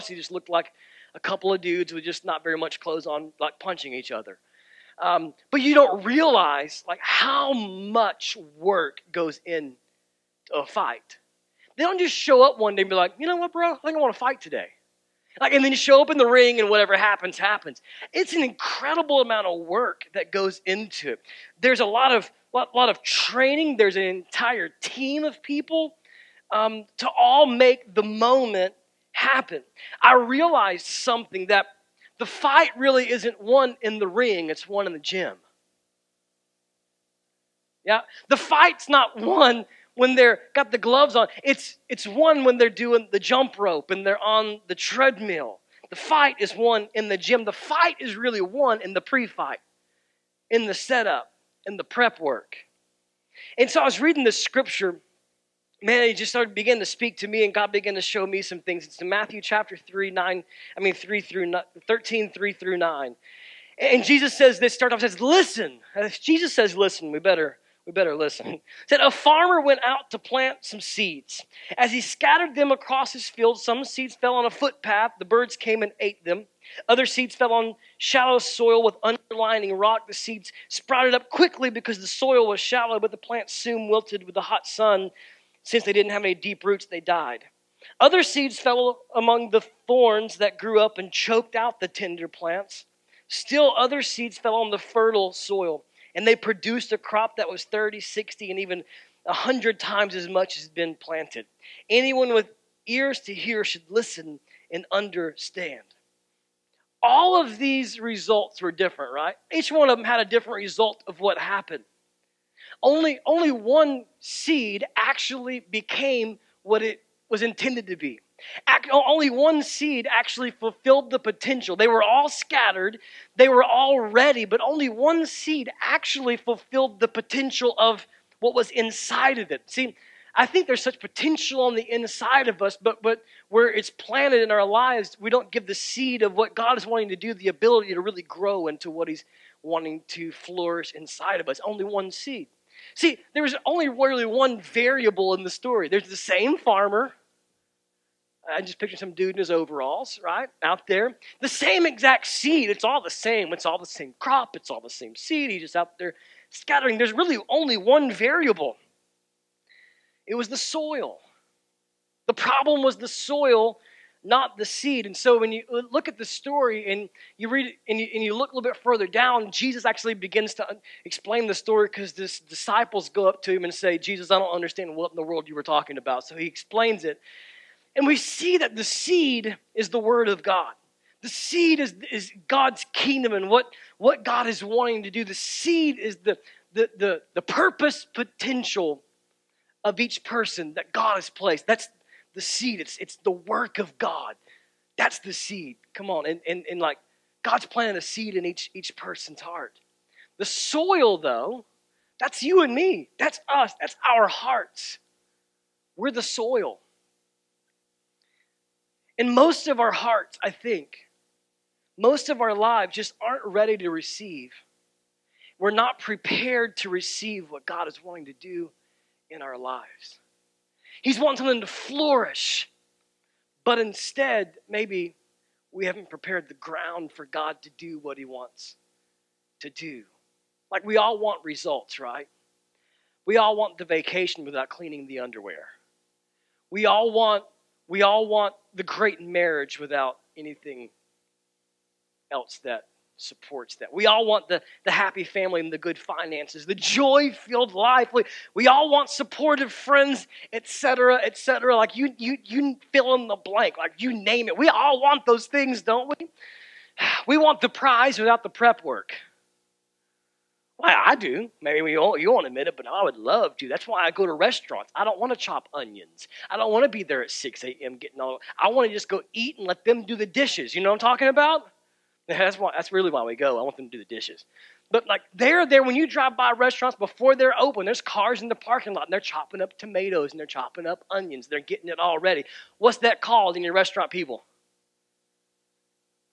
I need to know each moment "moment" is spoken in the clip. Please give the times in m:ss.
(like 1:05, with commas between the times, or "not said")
0:28.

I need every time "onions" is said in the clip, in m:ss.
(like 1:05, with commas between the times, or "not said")
4:25, 4:41.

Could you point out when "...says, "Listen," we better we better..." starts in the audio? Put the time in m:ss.
1:06.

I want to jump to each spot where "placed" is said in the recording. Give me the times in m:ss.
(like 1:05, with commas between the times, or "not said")
3:11.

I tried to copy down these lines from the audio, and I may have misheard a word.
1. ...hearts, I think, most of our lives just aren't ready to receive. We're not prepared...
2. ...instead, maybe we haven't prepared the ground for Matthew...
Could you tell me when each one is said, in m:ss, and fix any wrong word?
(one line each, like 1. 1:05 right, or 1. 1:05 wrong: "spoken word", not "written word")
1. 3:29 right
2. 3:43 wrong: "God", not "Matthew".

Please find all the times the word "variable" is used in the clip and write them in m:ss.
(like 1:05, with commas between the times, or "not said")
2:24, 2:38.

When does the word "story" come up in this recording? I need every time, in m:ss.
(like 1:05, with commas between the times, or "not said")
2:25, 2:46, 2:51.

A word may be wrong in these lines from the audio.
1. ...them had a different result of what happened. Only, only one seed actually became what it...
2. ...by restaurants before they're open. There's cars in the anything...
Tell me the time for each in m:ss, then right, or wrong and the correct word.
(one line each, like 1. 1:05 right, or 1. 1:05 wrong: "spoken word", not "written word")
1. 1:49 right
2. 4:36 wrong: "parking", not "anything".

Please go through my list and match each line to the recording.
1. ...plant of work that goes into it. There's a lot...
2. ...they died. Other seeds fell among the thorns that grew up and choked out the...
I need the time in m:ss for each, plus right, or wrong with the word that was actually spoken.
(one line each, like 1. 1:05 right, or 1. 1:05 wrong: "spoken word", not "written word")
1. 0:19 wrong: "amount", not "plant"
2. 1:26 right.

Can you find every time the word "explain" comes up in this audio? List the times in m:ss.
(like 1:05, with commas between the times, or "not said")
2:51, 2:56.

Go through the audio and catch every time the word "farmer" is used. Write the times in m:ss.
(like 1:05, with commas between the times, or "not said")
1:09, 2:26.